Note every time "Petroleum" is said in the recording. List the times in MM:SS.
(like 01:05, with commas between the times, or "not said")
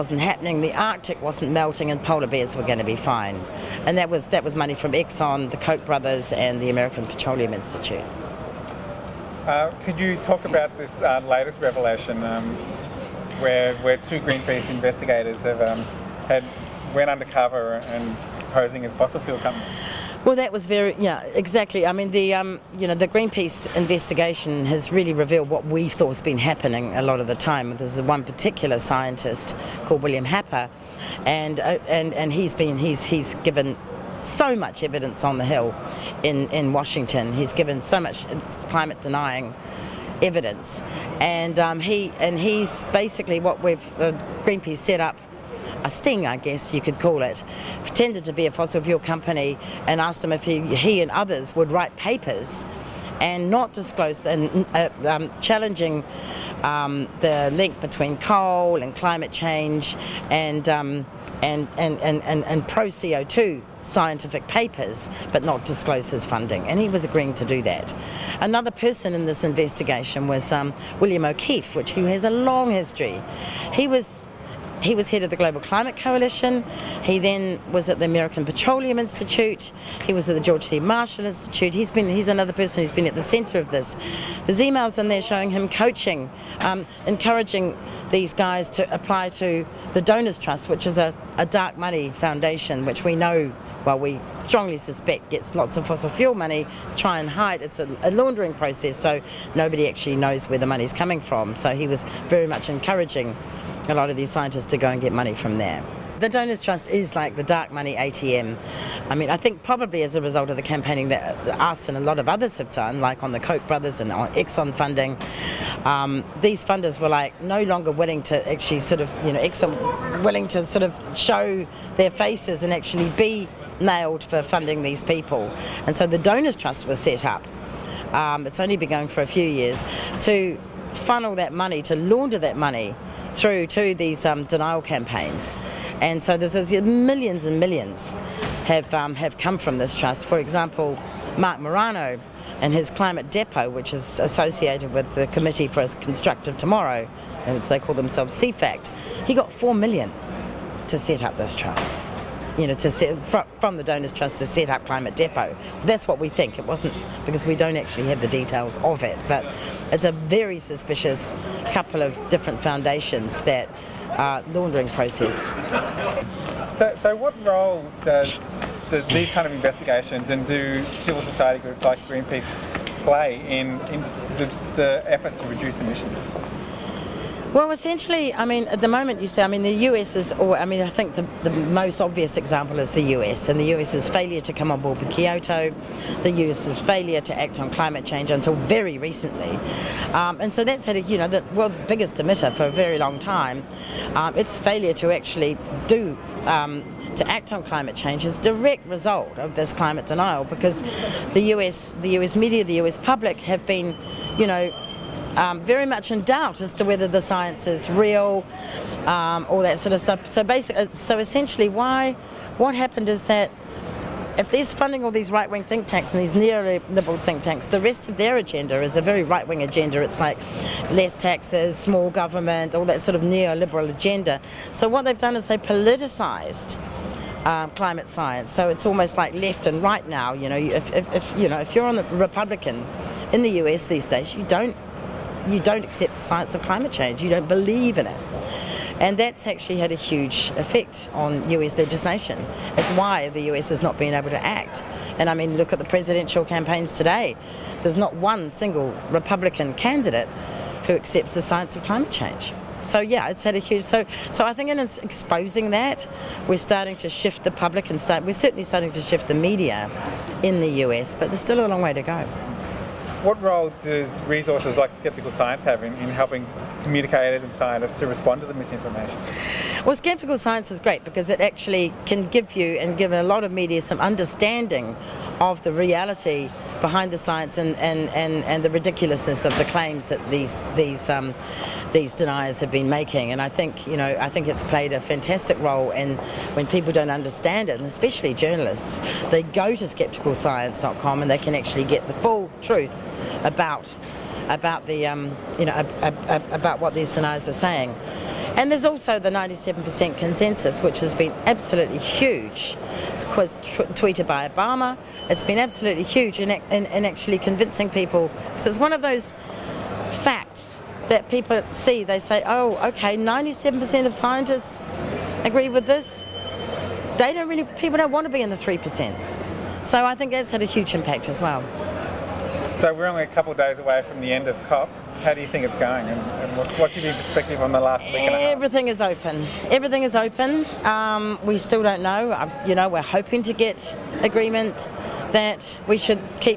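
00:07, 01:18.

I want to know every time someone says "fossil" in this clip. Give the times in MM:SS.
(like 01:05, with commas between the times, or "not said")
00:18, 00:48, 01:35.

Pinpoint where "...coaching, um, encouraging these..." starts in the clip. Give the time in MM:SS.
01:25.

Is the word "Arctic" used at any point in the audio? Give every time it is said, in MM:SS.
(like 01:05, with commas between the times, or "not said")
00:00.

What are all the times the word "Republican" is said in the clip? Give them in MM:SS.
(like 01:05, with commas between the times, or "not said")
03:52, 04:09.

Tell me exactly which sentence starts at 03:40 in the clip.
It's like less taxes, small government, all that sort of neoliberal agenda.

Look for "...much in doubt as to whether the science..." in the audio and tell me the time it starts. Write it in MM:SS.
03:25.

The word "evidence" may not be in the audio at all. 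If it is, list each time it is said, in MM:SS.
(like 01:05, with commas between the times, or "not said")
00:34, 00:40.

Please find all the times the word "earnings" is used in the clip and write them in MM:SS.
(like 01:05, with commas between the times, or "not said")
not said.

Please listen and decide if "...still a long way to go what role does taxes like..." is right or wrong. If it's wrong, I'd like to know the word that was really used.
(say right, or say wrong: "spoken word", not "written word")
wrong: "resources", not "taxes".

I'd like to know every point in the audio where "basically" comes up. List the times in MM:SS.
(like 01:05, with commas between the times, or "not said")
00:42, 03:30.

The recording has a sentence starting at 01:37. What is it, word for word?
It's a, a laundering process, so nobody actually knows where the money's coming from.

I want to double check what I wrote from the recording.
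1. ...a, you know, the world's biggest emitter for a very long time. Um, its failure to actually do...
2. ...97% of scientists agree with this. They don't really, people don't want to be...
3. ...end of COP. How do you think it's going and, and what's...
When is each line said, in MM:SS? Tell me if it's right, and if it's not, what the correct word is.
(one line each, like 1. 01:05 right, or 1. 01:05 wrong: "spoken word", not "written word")
1. 03:10 right
2. 05:13 right
3. 05:24 right.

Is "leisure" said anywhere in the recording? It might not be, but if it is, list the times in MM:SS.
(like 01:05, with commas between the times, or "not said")
not said.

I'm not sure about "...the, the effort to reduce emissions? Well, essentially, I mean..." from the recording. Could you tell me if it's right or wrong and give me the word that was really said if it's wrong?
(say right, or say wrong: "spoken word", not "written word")
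right.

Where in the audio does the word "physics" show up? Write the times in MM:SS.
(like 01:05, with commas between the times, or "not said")
not said.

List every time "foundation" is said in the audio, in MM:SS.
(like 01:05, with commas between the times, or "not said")
01:32, 02:42.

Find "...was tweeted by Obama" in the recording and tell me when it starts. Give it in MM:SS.
05:03.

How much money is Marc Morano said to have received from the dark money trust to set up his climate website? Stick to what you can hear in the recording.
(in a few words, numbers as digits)
4 million.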